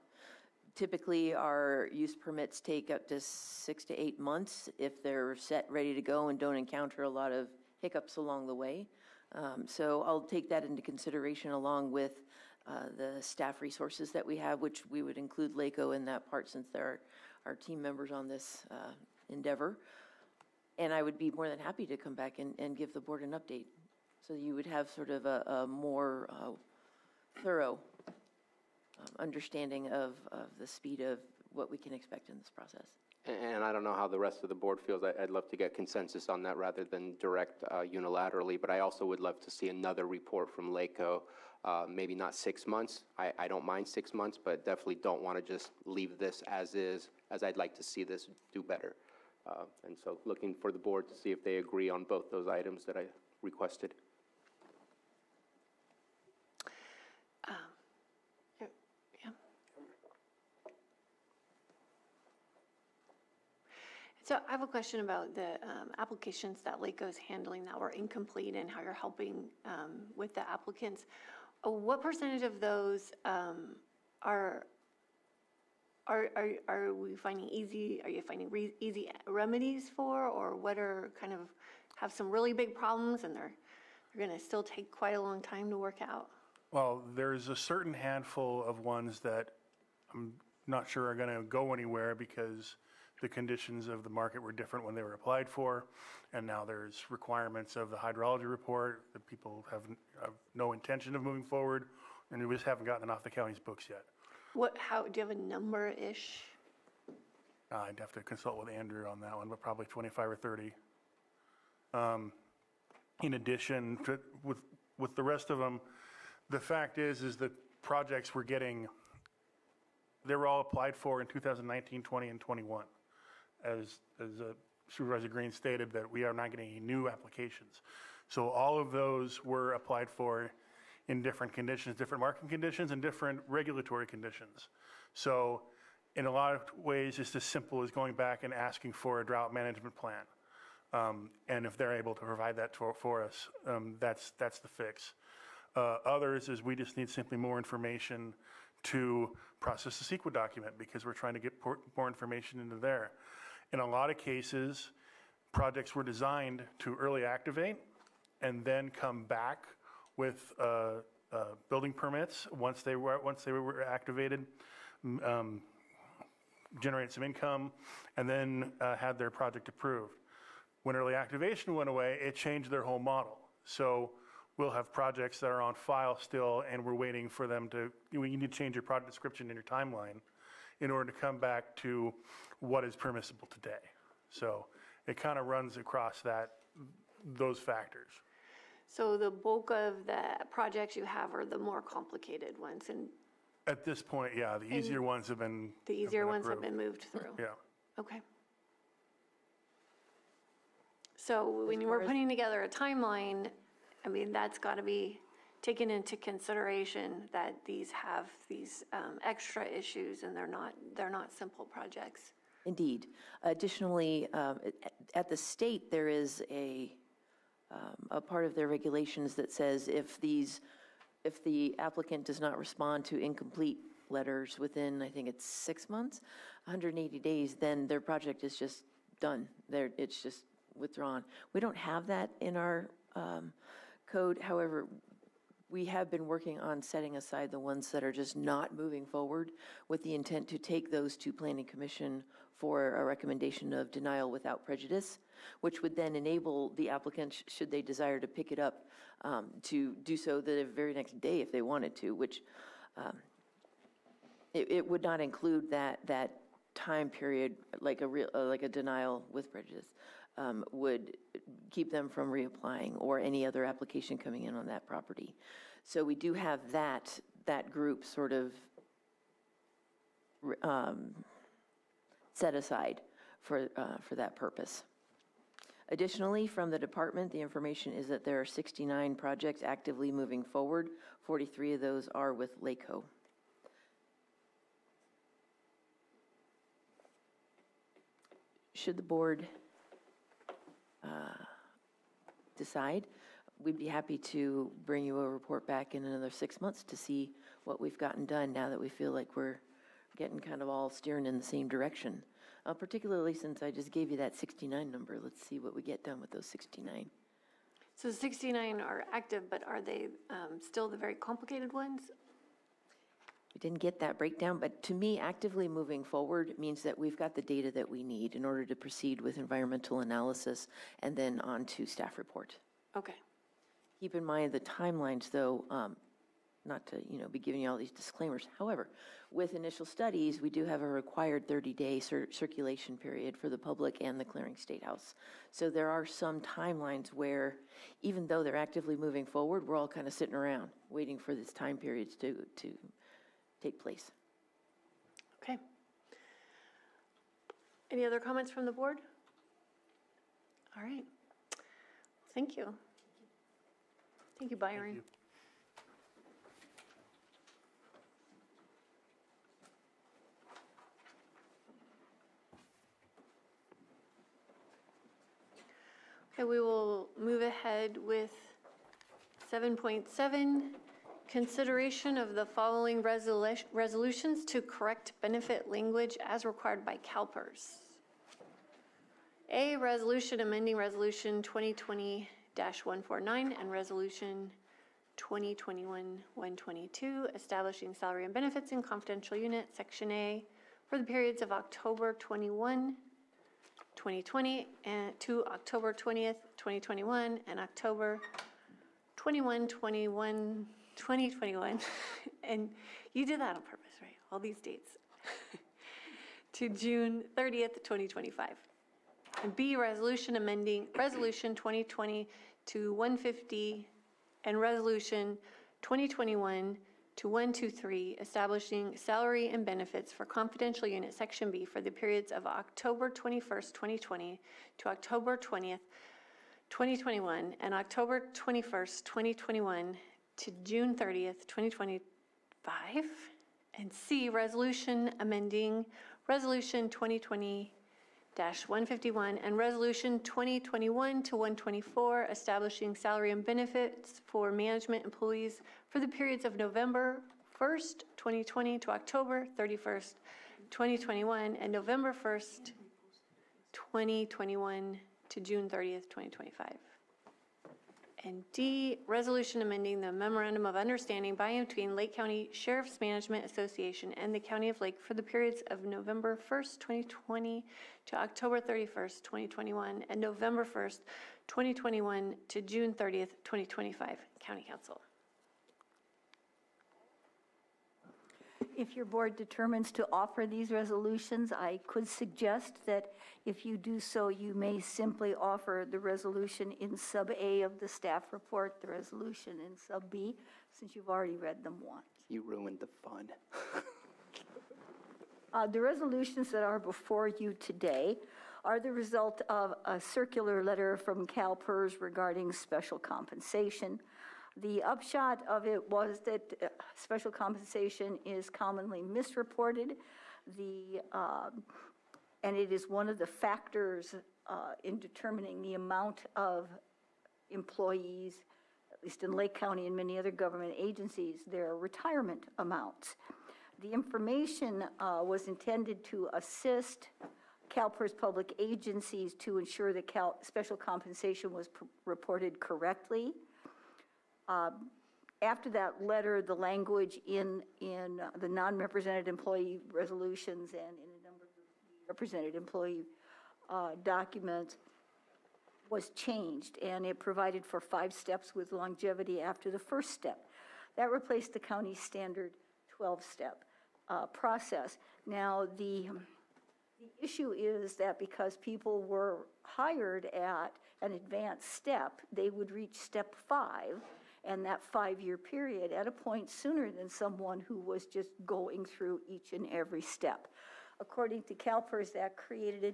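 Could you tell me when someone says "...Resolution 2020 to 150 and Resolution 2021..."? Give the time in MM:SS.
06:50.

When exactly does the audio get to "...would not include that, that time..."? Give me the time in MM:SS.
04:14.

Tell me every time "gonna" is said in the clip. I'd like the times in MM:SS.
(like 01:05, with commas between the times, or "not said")
01:24.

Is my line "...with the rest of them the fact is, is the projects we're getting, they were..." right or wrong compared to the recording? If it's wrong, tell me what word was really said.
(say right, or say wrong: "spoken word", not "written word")
right.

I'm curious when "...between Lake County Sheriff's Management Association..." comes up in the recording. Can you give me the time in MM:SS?
07:41.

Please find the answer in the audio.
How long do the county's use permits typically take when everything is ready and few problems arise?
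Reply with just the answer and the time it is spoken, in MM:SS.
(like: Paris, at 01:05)
6 to 8 months, at 00:03.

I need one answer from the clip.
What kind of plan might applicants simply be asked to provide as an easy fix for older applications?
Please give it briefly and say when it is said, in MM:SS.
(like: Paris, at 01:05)
drought management plan, at 02:19.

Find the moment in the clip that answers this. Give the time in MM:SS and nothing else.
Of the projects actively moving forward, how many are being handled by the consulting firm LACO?
04:41.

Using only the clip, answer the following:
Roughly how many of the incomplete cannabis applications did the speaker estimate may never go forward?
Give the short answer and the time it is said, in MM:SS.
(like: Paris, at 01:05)
25 or 30, at 01:49.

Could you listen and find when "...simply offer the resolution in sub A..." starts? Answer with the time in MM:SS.
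08:04.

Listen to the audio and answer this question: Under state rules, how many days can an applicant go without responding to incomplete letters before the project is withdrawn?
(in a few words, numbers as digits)
180 days.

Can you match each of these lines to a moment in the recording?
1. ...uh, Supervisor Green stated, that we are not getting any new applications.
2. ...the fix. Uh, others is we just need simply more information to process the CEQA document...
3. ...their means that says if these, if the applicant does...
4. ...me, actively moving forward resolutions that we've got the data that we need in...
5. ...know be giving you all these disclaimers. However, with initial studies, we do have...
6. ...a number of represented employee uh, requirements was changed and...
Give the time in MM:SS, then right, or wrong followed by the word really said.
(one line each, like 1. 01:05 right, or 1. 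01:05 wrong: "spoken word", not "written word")
1. 02:04 right
2. 02:24 right
3. 03:38 wrong: "regulations", not "means"
4. 05:14 wrong: "means", not "resolutions"
5. 05:27 right
6. 09:01 wrong: "documents", not "requirements".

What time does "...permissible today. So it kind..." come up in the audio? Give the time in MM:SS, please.
03:02.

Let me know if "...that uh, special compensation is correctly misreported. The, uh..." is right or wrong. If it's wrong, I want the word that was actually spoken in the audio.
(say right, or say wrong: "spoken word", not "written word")
wrong: "commonly", not "correctly".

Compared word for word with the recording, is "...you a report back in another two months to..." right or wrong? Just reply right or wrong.
wrong.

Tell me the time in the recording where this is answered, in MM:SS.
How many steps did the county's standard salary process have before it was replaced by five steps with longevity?
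09:12.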